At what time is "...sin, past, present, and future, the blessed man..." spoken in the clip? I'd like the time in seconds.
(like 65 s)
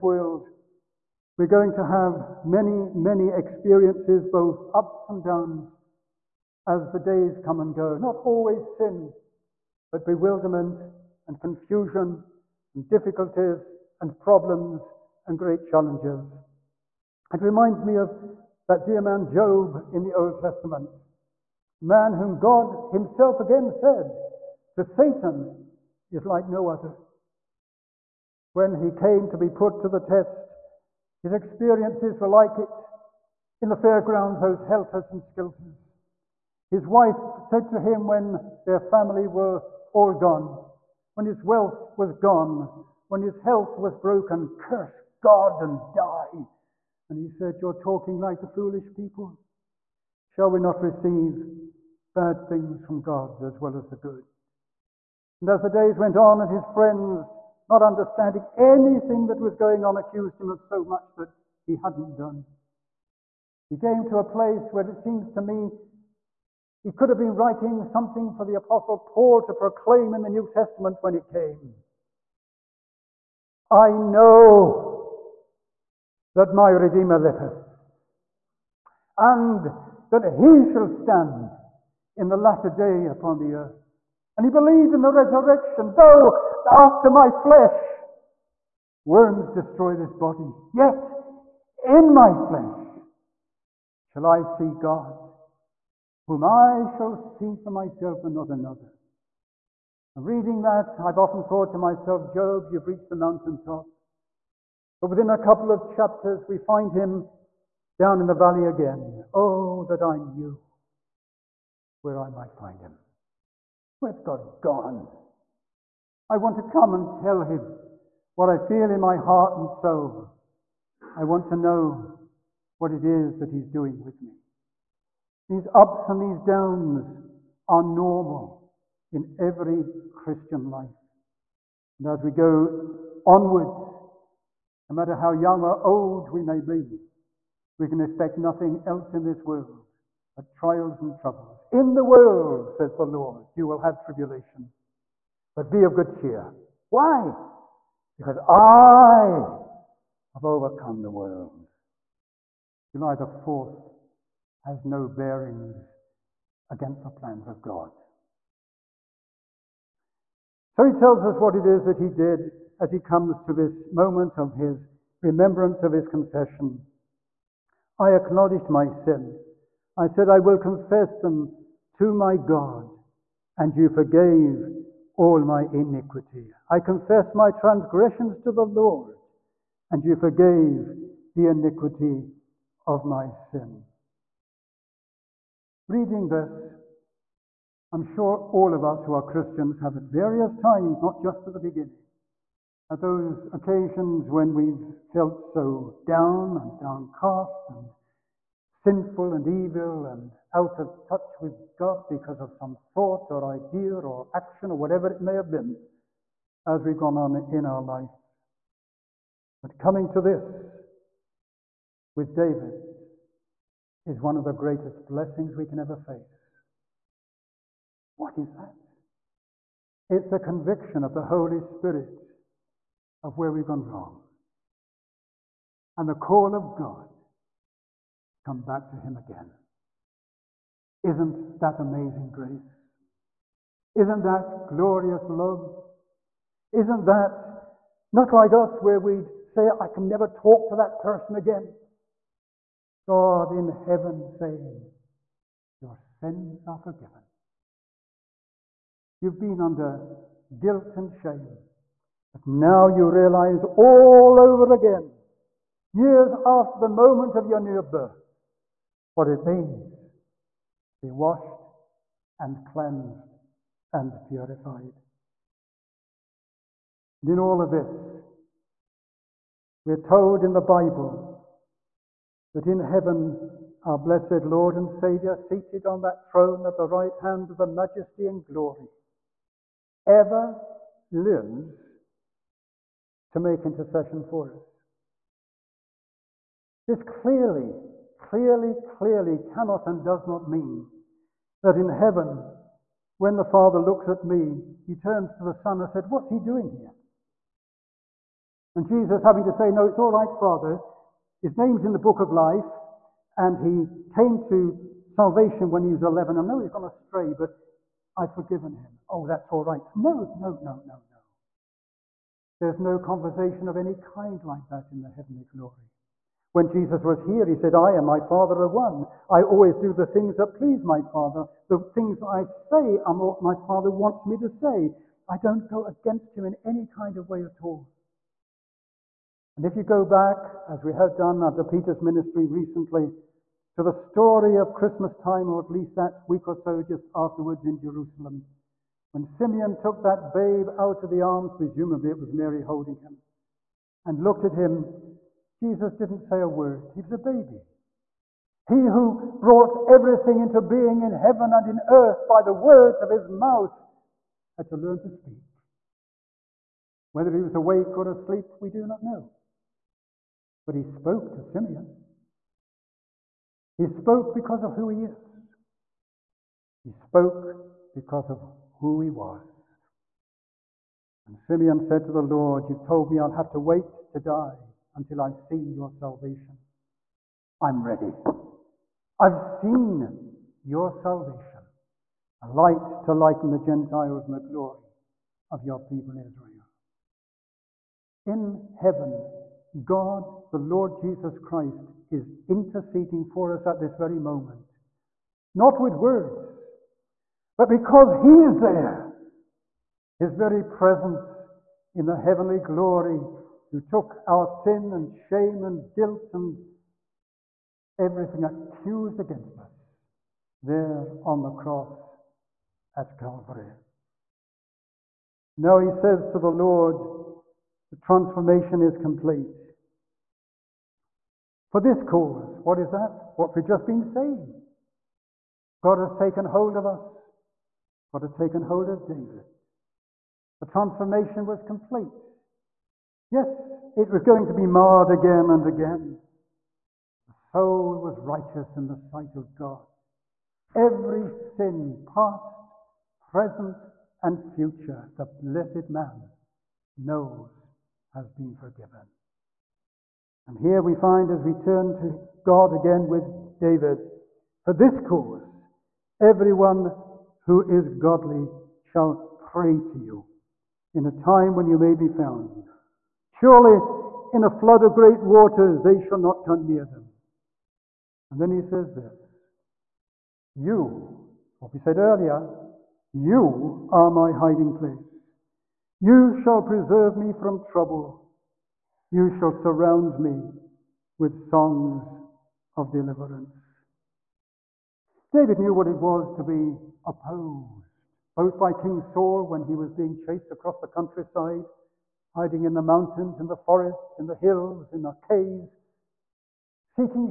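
441 s.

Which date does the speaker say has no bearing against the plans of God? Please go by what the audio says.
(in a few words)
July 4th.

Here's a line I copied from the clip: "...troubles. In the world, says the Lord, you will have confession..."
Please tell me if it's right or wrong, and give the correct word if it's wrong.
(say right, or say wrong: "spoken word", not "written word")
wrong: "tribulation", not "confession".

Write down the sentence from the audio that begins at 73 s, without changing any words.
I know that my Redeemer liveth, and that he shall stand in the latter day upon the earth.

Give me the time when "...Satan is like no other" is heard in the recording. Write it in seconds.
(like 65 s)
24 s.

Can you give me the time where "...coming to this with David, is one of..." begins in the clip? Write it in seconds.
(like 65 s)
209 s.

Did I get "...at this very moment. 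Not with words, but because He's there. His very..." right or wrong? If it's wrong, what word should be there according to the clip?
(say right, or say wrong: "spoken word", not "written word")
right.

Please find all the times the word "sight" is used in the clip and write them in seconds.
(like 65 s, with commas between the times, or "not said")
438 s.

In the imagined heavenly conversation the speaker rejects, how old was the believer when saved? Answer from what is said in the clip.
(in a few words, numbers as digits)
11.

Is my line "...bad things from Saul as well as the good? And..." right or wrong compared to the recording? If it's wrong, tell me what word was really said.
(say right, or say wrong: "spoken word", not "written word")
wrong: "God", not "Saul".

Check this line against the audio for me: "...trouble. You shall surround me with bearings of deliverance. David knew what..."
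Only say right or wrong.
wrong.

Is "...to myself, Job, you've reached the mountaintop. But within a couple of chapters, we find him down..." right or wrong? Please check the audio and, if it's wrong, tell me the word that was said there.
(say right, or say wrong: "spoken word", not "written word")
right.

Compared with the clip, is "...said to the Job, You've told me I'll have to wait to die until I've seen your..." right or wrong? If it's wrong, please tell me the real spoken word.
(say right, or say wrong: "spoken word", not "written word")
wrong: "Lord", not "Job".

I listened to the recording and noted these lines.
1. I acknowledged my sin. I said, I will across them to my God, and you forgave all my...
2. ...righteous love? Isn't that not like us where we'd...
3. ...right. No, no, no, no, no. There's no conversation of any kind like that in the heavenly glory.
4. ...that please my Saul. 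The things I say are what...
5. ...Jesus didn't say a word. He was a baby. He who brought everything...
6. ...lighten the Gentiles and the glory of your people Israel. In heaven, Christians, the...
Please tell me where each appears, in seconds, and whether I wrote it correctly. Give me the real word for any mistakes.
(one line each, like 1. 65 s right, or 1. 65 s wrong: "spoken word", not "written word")
1. 167 s wrong: "confess", not "across"
2. 234 s wrong: "glorious", not "righteous"
3. 309 s right
4. 320 s wrong: "Father", not "Saul"
5. 345 s right
6. 383 s wrong: "God", not "Christians".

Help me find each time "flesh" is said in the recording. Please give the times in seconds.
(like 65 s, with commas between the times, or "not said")
87 s, 92 s.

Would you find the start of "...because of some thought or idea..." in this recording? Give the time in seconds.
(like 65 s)
202 s.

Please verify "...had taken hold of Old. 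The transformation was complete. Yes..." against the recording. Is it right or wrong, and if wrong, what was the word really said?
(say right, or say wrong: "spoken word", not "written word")
wrong: "David", not "Old".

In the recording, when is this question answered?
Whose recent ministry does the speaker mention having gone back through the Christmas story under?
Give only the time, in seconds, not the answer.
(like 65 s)
331 s.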